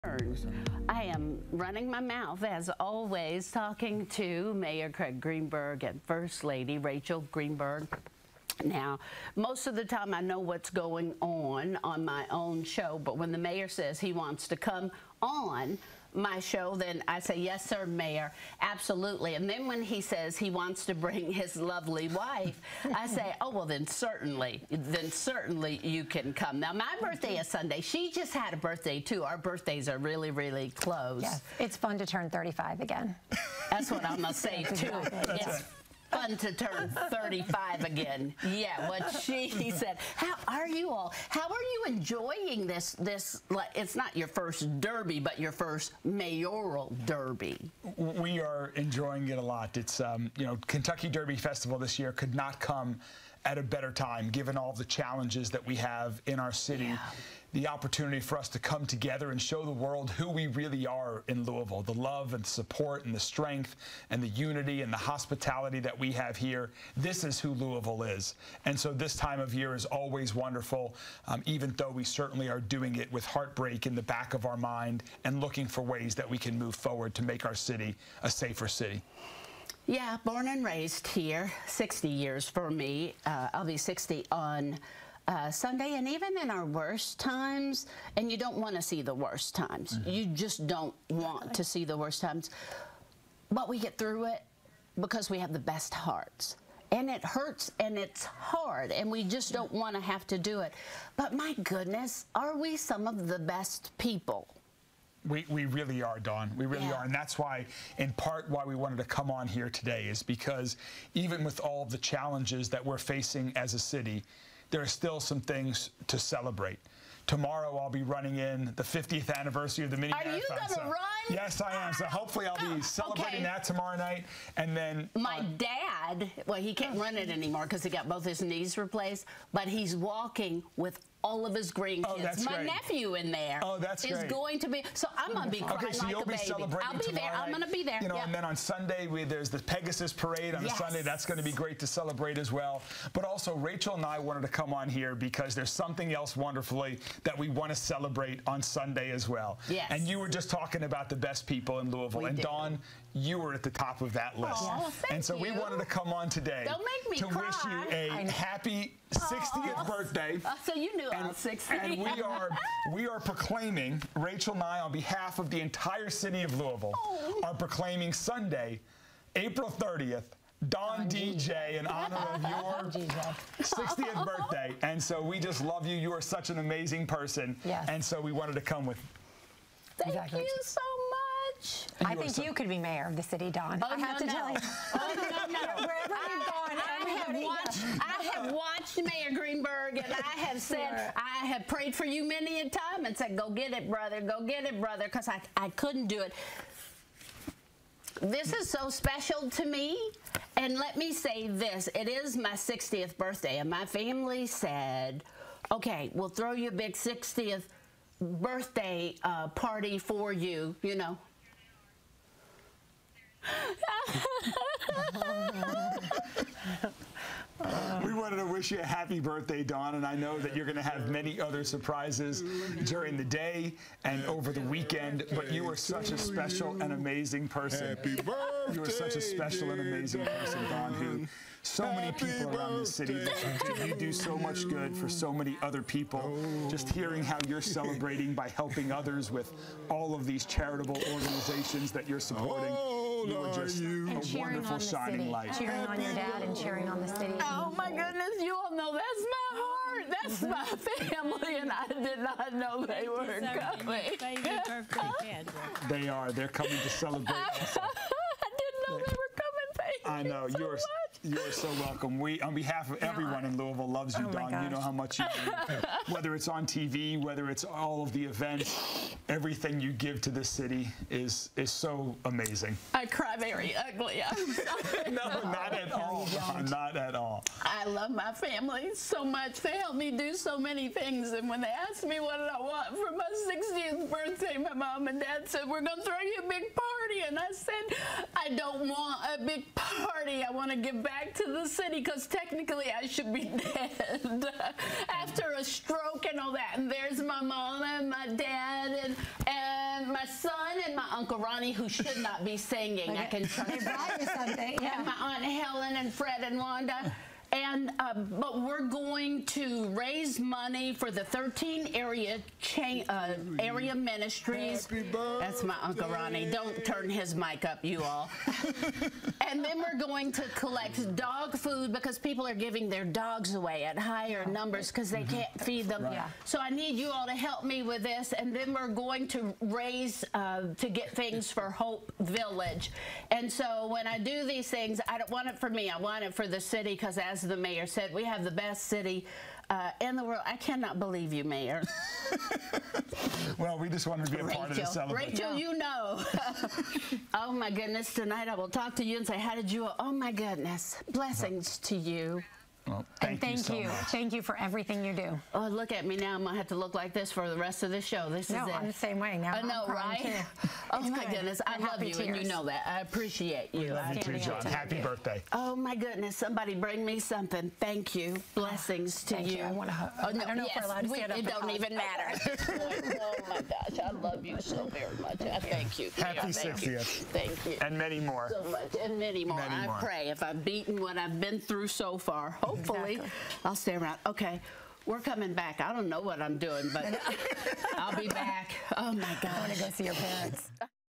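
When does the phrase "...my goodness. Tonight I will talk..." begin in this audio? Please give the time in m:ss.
5:47.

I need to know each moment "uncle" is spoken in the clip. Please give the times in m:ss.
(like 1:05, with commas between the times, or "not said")
5:01, 5:15.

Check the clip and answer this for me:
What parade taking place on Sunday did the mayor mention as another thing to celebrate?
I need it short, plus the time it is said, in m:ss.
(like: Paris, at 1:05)
Pegasus parade, at 2:19.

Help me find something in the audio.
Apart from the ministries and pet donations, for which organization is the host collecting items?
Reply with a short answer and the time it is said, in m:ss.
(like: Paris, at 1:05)
Hope Village, at 5:31.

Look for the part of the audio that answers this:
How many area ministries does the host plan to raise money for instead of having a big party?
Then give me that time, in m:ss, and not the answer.
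5:11.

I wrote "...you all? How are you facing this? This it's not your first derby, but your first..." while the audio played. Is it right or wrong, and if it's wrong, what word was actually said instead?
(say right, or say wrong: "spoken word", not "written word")
wrong: "enjoying", not "facing".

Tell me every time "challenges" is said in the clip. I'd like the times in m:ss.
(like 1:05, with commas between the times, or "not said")
0:54, 1:51.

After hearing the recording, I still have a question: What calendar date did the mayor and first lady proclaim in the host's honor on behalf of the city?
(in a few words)
April 30th.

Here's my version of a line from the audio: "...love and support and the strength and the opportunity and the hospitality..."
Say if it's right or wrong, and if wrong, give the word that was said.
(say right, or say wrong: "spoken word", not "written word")
wrong: "unity", not "opportunity".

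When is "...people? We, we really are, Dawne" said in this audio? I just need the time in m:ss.
1:43.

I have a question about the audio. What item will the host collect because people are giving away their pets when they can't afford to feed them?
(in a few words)
Dog food.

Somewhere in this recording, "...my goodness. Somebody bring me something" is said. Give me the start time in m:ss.
6:05.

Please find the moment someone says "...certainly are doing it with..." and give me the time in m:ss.
1:12.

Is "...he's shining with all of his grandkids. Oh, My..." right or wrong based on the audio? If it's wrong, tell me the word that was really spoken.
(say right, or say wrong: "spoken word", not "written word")
wrong: "walking", not "shining".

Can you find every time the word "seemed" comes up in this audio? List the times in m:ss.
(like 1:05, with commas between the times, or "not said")
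not said.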